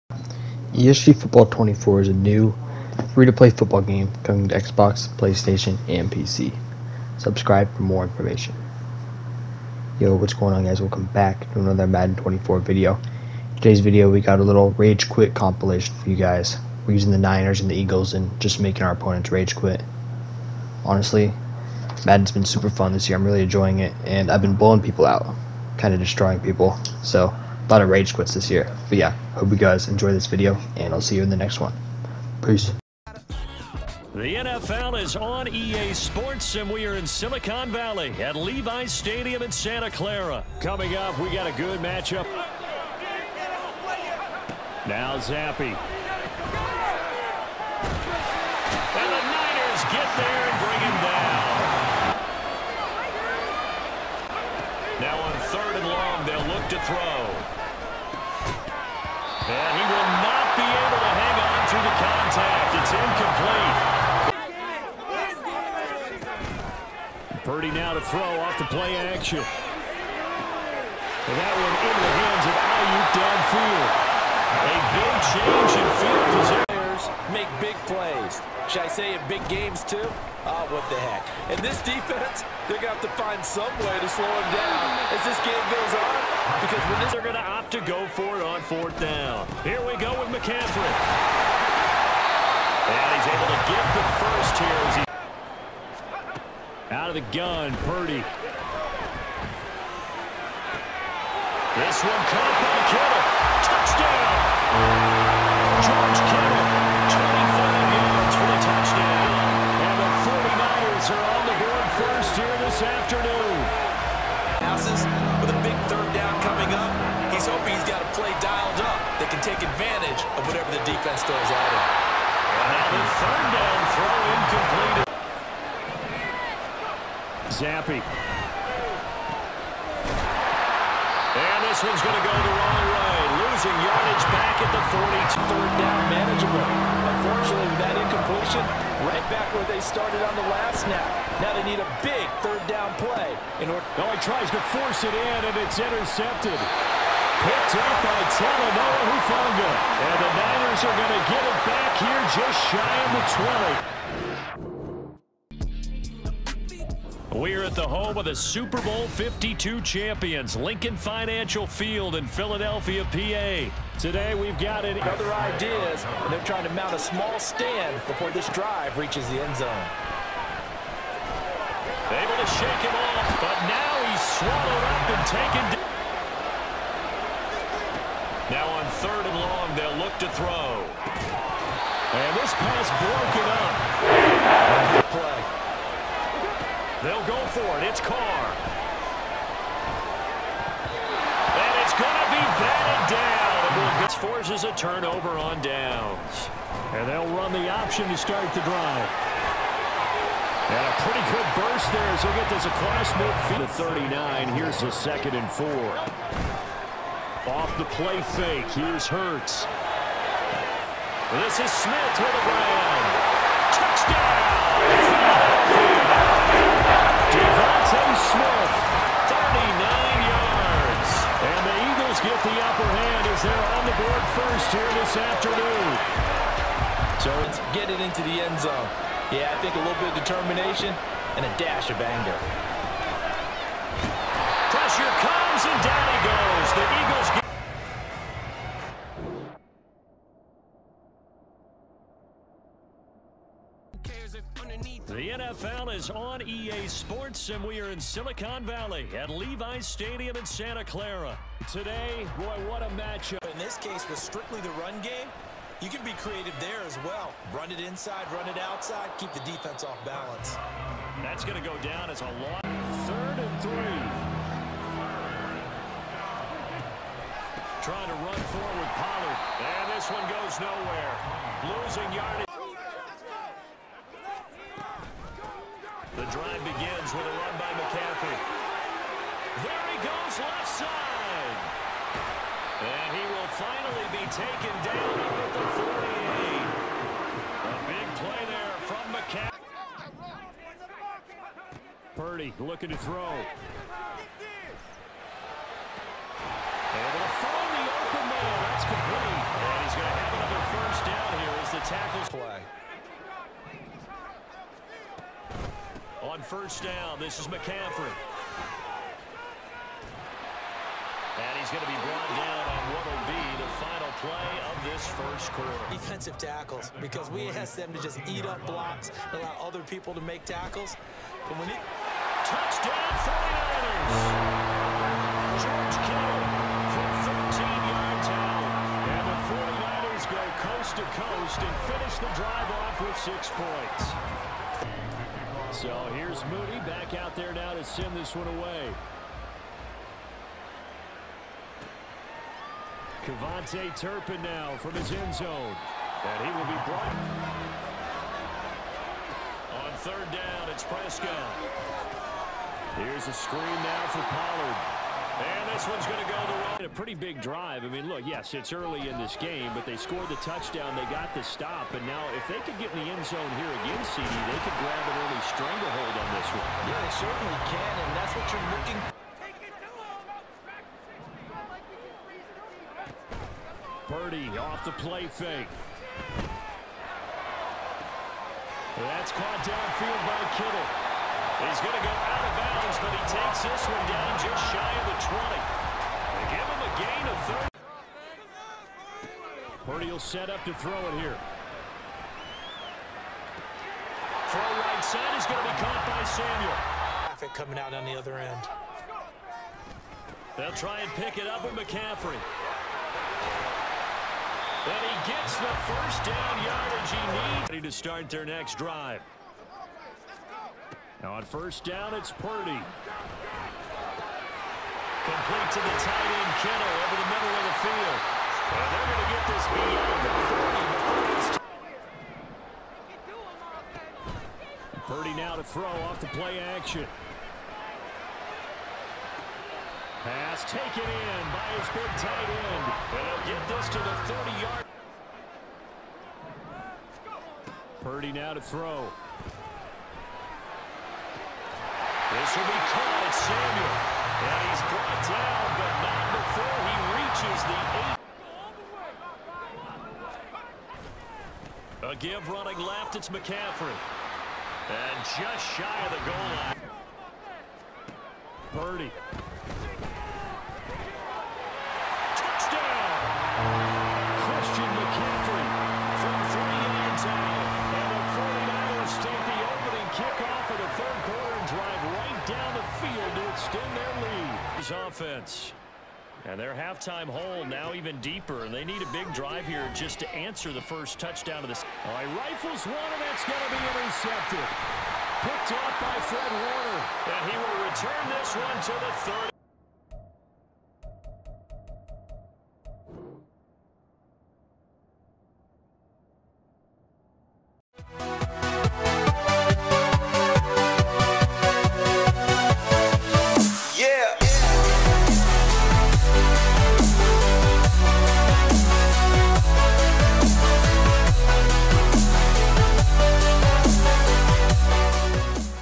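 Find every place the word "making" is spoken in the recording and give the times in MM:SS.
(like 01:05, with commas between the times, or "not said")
00:18.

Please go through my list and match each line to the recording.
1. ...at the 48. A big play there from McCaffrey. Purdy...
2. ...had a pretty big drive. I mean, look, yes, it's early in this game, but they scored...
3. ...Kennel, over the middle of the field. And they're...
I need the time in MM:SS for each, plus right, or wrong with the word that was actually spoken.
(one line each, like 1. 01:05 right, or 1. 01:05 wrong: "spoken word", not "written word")
1. 04:45 right
2. 05:56 right
3. 06:56 right.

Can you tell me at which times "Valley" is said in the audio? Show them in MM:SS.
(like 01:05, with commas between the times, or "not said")
00:37, 04:08.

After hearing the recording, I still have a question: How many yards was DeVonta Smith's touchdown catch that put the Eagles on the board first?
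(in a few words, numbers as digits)
39.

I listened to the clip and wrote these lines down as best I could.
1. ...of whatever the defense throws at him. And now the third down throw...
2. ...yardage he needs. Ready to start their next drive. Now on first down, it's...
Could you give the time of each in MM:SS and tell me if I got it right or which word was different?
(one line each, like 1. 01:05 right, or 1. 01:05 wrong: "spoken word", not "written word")
1. 02:00 right
2. 06:46 right.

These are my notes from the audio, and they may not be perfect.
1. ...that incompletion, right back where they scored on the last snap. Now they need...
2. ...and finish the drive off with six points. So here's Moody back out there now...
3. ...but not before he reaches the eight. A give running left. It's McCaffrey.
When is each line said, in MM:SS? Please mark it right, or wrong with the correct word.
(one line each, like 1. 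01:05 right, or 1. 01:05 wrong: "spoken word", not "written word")
1. 02:17 wrong: "started", not "scored"
2. 05:31 right
3. 07:25 right.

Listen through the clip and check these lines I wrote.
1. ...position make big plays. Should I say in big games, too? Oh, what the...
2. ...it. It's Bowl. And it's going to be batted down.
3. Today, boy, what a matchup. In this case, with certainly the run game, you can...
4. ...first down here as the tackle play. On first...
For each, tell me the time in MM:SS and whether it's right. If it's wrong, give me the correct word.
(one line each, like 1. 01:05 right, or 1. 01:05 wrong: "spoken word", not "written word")
1. 01:16 right
2. 03:07 wrong: "Carr", not "Bowl"
3. 04:11 wrong: "strictly", not "certainly"
4. 05:00 right.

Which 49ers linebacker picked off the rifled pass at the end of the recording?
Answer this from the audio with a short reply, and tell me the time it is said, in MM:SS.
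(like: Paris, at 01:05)
Fred Warner, at 08:06.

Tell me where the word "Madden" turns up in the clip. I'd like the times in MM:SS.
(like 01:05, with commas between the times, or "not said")
00:11, 00:22.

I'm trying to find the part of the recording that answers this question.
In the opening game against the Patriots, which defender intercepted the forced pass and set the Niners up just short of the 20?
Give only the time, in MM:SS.
02:28.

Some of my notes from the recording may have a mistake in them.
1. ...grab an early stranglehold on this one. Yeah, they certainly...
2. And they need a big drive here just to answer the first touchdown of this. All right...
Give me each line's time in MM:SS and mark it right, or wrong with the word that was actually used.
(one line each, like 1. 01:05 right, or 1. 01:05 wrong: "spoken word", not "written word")
1. 06:04 right
2. 07:58 right.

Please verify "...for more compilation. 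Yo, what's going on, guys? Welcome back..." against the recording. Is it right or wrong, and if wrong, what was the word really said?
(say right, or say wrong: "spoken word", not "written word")
wrong: "information", not "compilation".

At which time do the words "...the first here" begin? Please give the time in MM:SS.
01:33.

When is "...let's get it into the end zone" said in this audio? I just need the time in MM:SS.
03:47.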